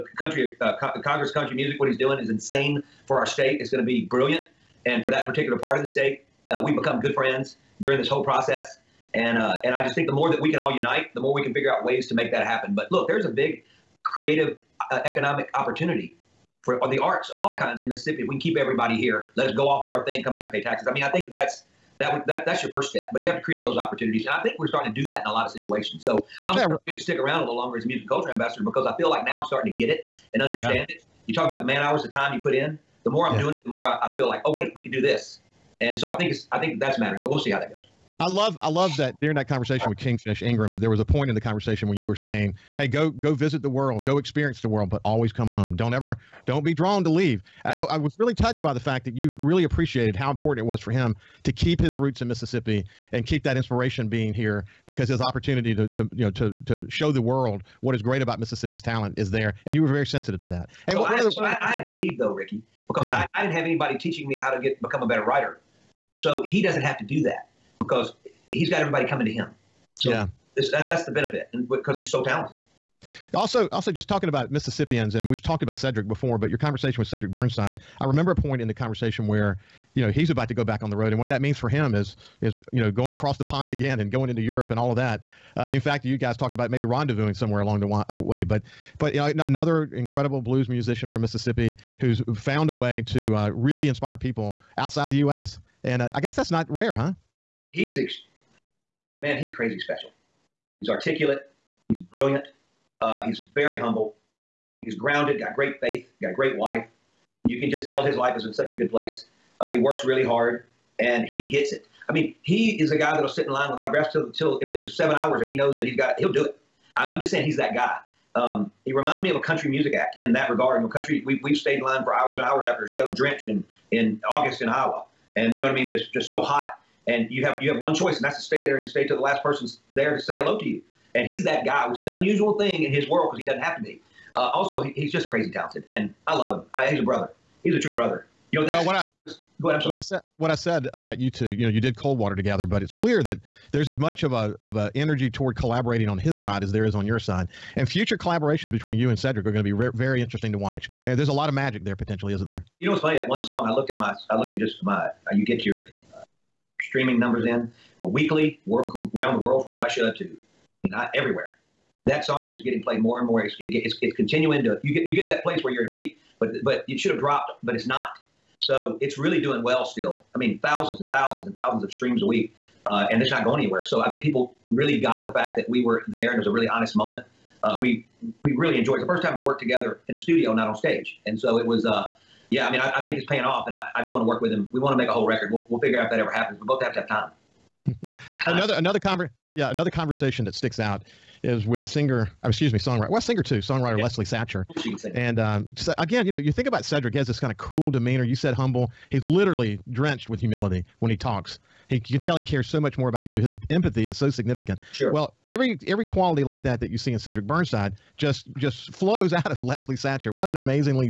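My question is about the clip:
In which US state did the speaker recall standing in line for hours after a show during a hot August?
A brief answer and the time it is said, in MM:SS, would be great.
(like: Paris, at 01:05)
Iowa, at 02:04.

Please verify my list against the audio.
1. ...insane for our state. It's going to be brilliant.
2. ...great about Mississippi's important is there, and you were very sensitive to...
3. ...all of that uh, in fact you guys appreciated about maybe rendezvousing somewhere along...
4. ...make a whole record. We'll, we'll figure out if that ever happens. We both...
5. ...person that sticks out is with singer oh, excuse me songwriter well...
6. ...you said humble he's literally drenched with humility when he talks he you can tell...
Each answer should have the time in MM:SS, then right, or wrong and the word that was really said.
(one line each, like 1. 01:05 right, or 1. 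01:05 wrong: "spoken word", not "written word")
1. 00:02 right
2. 00:58 wrong: "talent", not "important"
3. 01:24 wrong: "talked", not "appreciated"
4. 03:04 right
5. 03:09 wrong: "conversation", not "person"
6. 03:18 right.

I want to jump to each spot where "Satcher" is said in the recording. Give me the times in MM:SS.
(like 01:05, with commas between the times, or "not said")
03:14, 03:29.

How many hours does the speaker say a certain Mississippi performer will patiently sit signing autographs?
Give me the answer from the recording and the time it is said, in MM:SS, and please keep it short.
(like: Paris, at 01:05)
7, at 01:54.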